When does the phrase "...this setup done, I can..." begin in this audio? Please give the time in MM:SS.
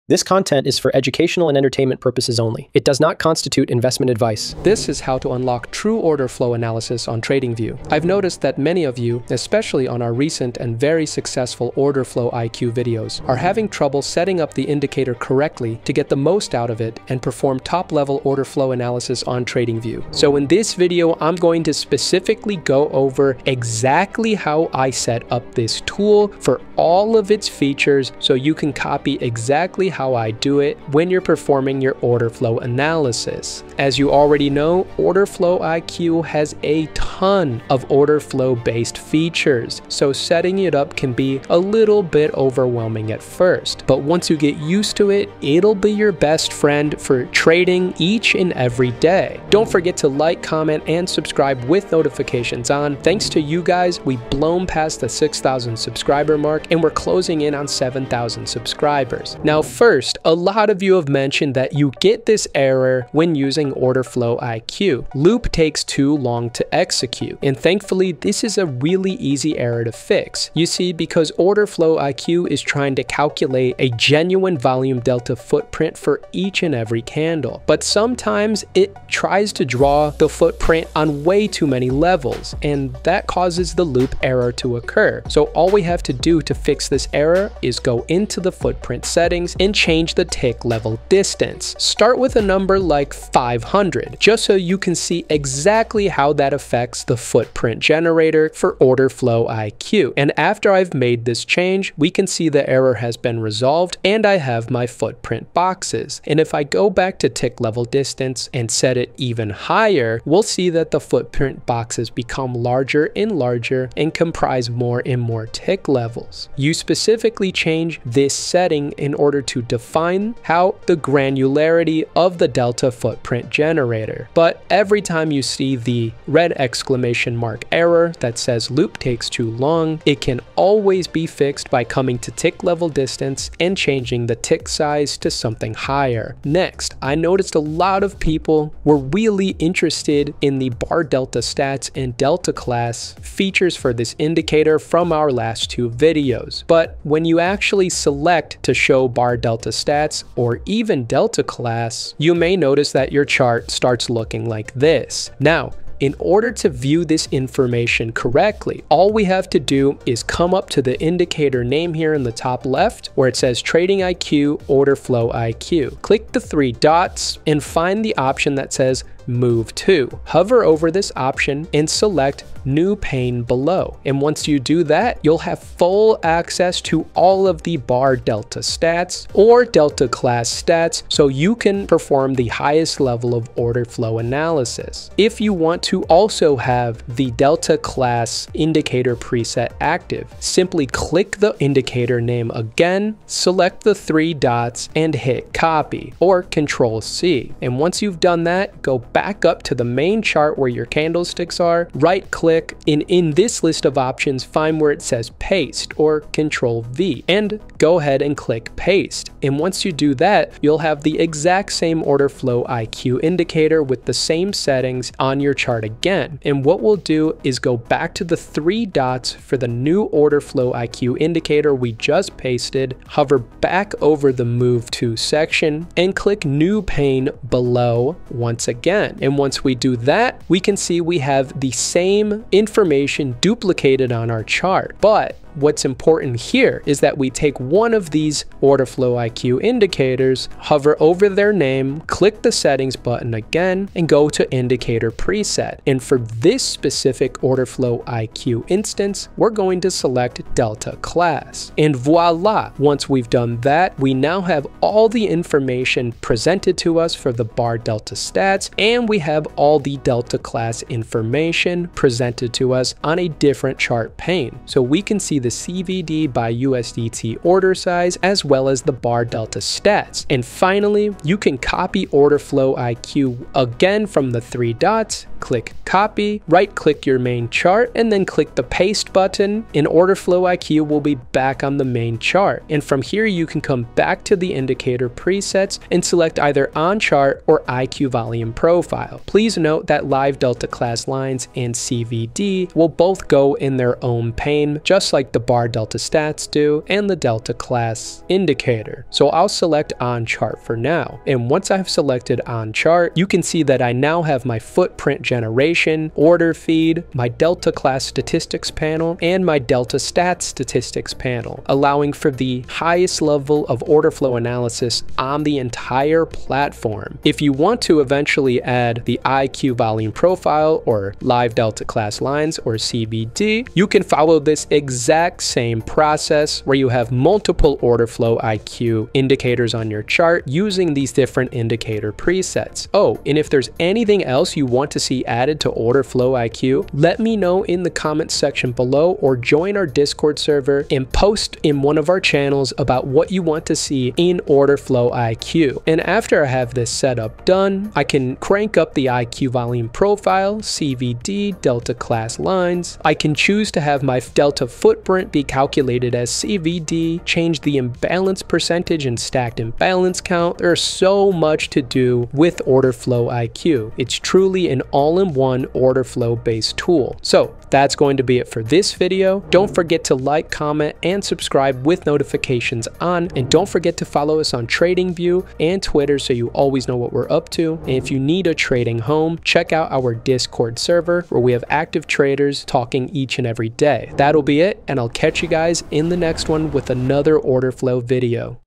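05:46.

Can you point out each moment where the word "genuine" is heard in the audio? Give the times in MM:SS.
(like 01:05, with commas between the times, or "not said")
01:13.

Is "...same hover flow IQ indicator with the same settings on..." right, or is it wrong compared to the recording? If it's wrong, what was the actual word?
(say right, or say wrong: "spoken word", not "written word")
wrong: "order", not "hover".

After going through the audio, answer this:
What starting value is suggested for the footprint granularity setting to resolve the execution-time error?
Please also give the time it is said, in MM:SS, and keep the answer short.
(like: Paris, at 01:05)
500, at 01:33.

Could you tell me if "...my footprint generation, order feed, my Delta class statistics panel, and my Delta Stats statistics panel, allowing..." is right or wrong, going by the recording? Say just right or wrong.
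right.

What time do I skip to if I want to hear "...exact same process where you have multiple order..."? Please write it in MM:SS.
05:24.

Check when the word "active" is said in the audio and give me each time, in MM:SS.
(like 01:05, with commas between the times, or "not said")
03:09, 06:21.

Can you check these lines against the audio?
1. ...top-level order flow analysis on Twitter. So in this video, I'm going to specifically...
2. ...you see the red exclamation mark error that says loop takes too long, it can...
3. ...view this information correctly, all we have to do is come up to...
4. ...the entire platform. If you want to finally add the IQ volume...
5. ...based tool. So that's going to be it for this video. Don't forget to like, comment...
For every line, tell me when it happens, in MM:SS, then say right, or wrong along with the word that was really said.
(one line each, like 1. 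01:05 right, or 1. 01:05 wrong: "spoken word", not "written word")
1. 00:17 wrong: "TradingView", not "Twitter"
2. 02:05 right
3. 02:36 right
4. 05:15 wrong: "eventually", not "finally"
5. 06:06 right.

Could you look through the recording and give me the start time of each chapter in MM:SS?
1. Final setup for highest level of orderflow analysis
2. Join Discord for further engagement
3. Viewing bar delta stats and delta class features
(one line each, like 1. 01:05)
1. 05:00
2. 06:04
3. 02:18.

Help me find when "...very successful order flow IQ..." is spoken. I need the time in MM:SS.
00:10.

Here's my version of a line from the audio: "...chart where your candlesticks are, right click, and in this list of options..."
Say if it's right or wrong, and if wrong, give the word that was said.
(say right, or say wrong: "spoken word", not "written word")
right.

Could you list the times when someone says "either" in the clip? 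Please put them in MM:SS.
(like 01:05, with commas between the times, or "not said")
04:46.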